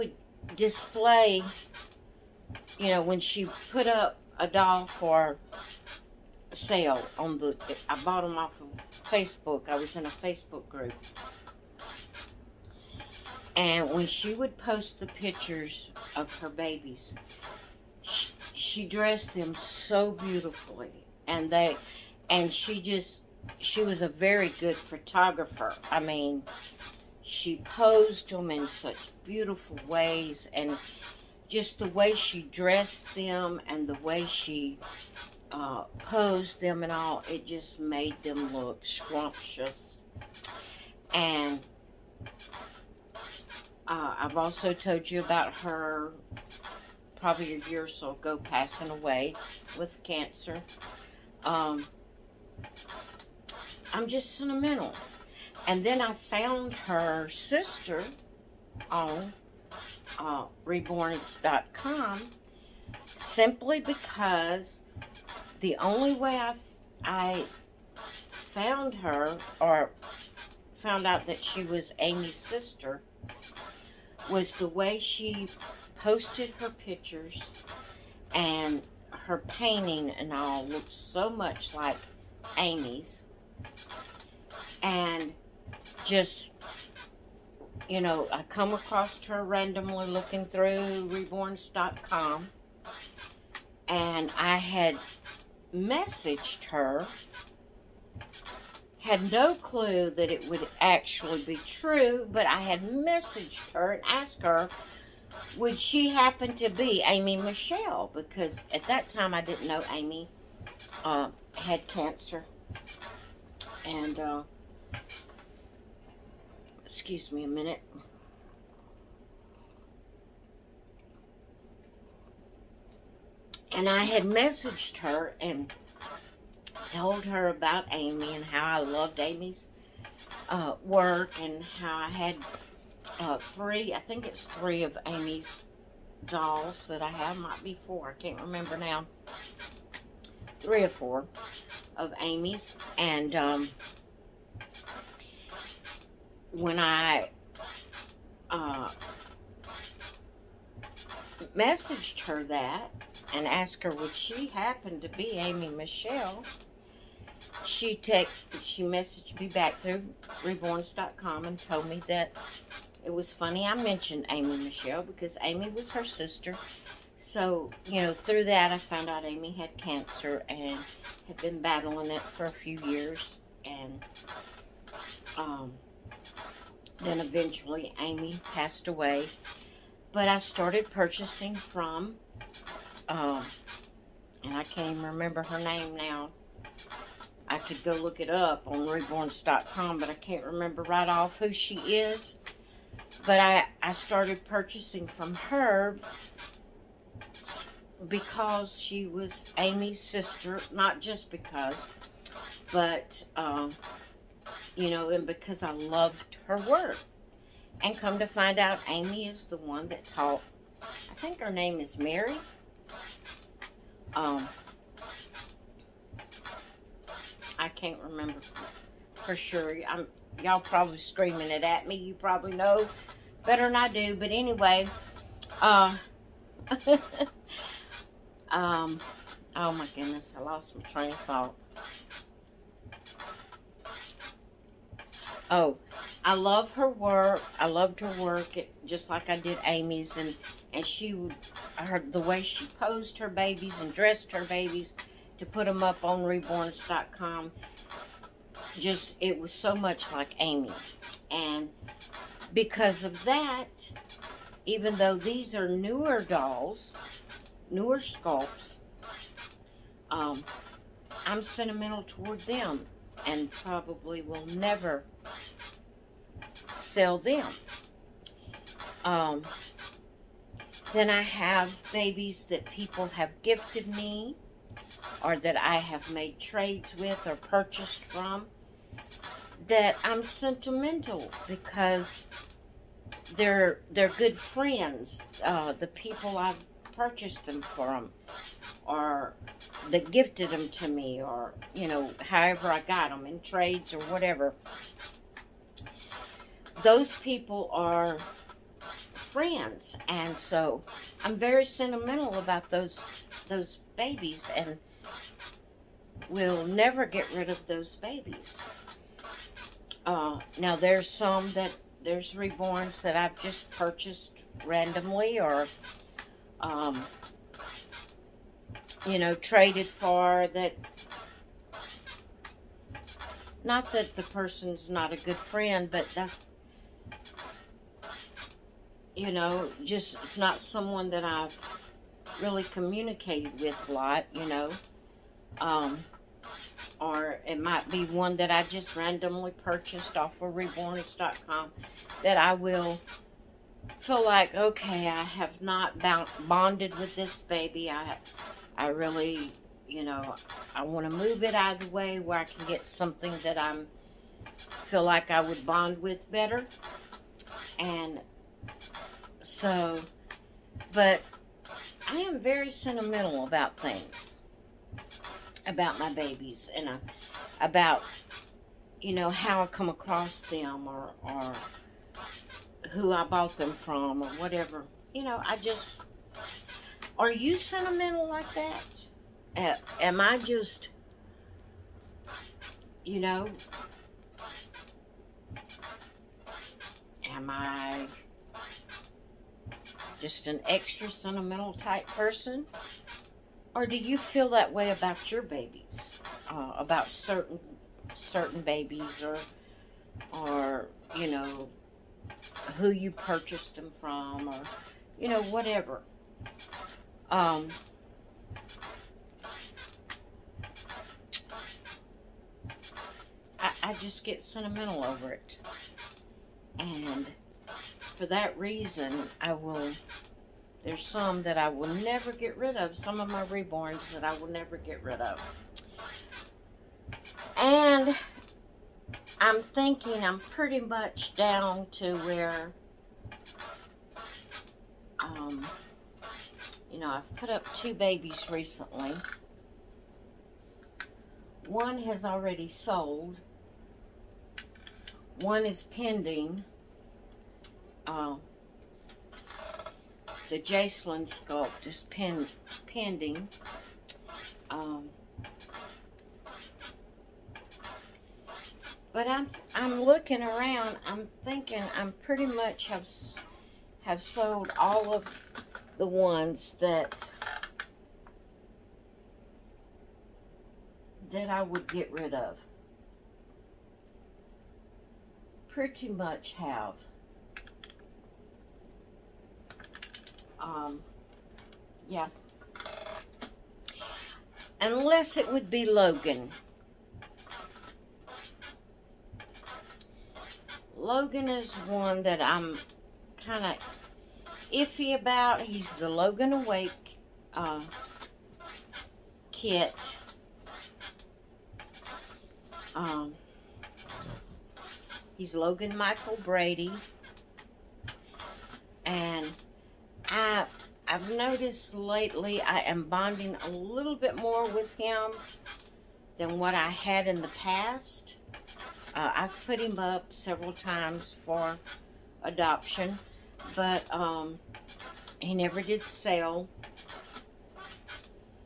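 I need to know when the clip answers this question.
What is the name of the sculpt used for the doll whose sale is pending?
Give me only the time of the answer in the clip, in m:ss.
7:30.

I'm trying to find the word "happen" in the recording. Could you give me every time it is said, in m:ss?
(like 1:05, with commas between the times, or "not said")
1:46, 2:34.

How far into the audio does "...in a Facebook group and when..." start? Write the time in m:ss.
0:09.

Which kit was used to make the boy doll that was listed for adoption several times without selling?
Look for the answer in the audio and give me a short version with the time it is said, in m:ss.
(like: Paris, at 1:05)
Logan Awake, at 8:15.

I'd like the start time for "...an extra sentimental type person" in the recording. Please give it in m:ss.
6:30.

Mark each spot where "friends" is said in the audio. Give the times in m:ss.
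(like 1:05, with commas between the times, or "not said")
4:44, 4:59, 5:25.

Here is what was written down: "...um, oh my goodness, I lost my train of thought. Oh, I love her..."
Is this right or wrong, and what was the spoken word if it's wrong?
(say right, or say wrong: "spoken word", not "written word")
right.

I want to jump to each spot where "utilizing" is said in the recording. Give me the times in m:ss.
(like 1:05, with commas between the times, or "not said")
not said.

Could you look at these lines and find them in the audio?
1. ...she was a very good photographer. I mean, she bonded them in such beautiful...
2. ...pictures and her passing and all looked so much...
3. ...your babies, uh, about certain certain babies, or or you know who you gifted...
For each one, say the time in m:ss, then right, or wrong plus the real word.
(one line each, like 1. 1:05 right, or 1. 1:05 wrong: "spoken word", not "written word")
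1. 0:23 wrong: "posed", not "bonded"
2. 1:16 wrong: "painting", not "passing"
3. 6:35 wrong: "purchased", not "gifted".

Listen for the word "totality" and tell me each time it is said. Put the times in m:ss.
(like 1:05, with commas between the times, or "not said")
not said.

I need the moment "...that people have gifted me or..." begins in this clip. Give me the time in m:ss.
4:32.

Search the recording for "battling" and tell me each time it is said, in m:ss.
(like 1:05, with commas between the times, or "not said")
2:51.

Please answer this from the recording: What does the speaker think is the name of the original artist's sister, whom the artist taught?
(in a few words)
Mary.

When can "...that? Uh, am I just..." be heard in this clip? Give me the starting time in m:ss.
6:18.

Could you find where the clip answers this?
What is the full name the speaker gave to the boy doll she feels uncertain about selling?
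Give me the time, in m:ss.
8:25.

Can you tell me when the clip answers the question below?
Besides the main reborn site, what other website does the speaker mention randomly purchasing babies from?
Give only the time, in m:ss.
5:40.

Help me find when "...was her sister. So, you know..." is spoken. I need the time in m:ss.
2:45.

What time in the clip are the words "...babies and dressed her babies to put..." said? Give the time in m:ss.
4:03.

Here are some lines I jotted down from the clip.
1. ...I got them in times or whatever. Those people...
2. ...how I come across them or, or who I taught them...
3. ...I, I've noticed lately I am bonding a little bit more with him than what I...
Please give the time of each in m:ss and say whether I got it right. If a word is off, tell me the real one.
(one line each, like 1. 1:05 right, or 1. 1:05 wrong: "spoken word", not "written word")
1. 4:52 wrong: "trades", not "times"
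2. 6:09 wrong: "bought", not "taught"
3. 8:30 right.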